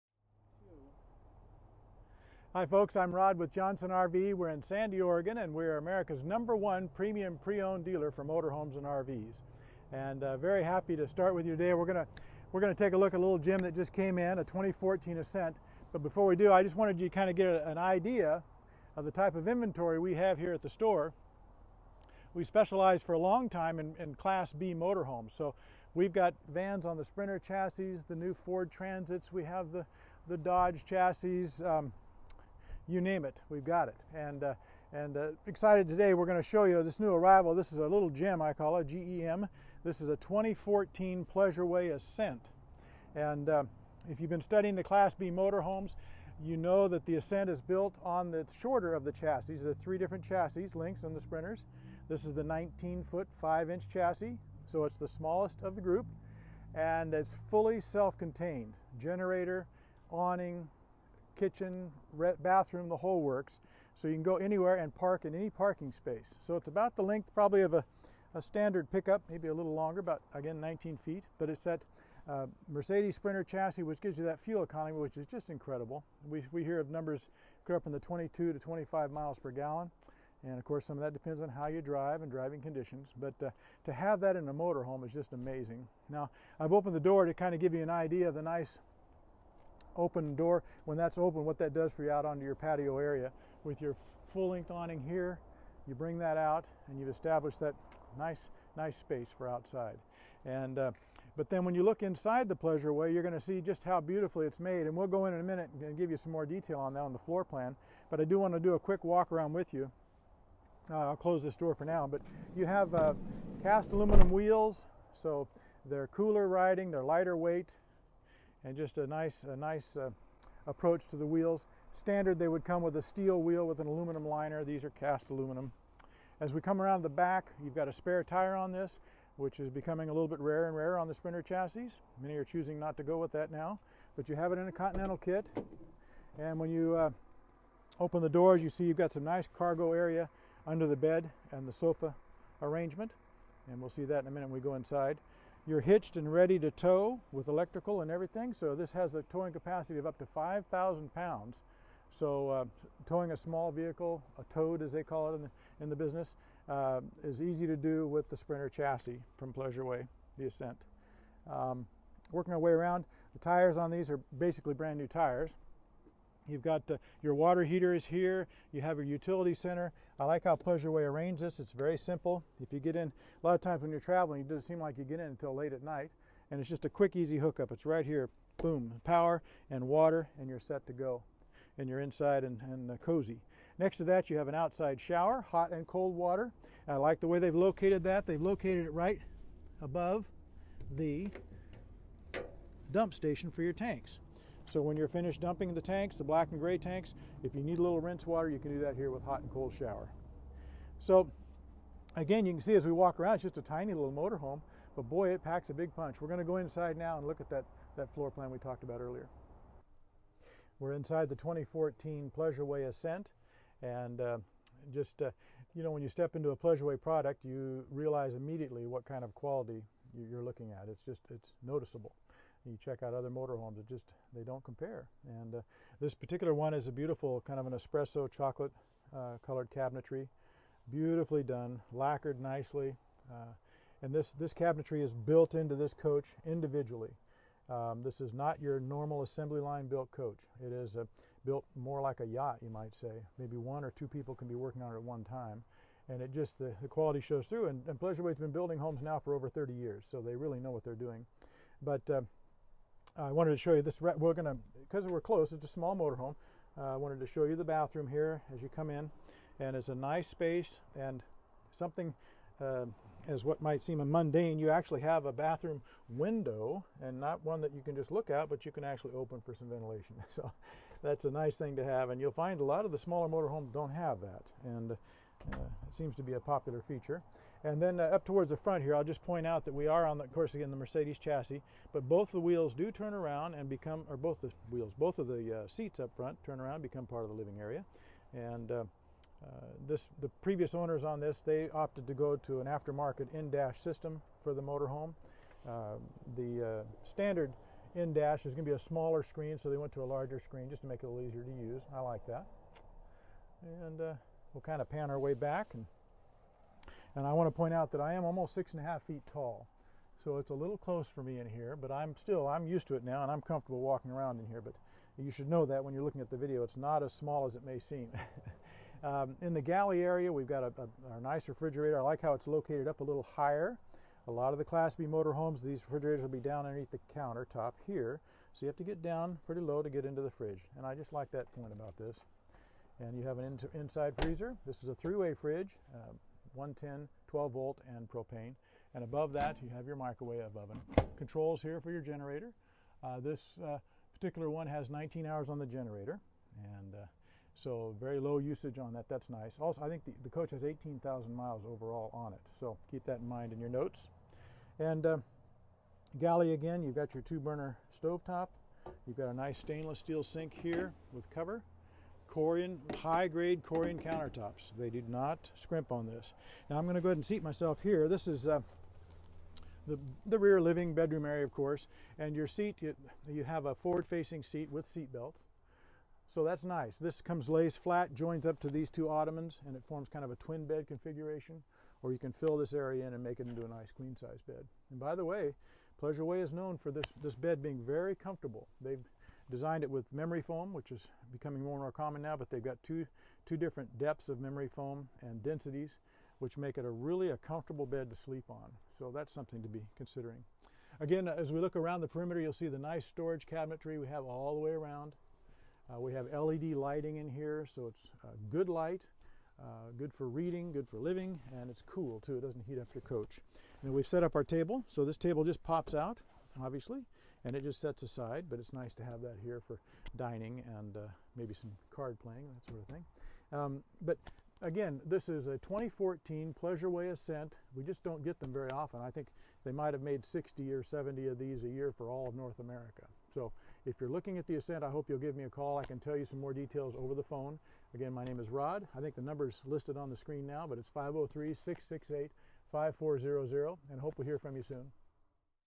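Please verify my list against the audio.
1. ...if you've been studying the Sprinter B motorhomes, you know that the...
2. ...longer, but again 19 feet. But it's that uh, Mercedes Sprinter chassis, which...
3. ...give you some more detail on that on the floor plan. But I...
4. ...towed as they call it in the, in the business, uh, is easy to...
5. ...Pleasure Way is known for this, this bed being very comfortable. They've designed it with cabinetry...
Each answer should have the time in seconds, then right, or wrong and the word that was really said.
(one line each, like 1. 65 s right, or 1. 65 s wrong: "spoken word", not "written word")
1. 44 s wrong: "Class", not "Sprinter"
2. 69 s right
3. 105 s right
4. 154 s right
5. 385 s wrong: "memory", not "cabinetry".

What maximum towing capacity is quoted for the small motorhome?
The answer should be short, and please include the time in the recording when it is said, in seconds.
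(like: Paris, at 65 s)
5,000 pounds, at 150 s.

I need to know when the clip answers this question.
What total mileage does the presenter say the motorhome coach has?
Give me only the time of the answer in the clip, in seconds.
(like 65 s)
350 s.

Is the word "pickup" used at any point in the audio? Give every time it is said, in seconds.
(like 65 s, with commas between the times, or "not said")
68 s.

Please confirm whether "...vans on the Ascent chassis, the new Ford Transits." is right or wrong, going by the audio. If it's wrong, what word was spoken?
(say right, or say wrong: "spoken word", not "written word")
wrong: "Sprinter", not "Ascent".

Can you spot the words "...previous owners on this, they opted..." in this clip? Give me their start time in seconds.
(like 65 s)
290 s.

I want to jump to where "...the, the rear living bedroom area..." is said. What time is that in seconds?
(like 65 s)
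369 s.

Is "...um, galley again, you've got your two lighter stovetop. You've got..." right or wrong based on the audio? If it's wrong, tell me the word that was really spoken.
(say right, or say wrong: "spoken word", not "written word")
wrong: "burner", not "lighter".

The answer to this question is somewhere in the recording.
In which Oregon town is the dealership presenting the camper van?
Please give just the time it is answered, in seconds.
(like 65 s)
4 s.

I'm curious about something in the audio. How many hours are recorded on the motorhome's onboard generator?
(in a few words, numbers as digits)
19 hours.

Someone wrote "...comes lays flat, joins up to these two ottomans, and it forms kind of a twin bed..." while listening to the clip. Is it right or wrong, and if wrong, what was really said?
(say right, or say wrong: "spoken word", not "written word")
right.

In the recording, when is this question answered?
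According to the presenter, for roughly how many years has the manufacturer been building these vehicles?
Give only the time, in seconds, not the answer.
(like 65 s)
249 s.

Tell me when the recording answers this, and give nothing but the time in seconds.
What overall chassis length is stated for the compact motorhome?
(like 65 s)
52 s.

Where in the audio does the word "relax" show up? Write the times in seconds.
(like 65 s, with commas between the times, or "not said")
not said.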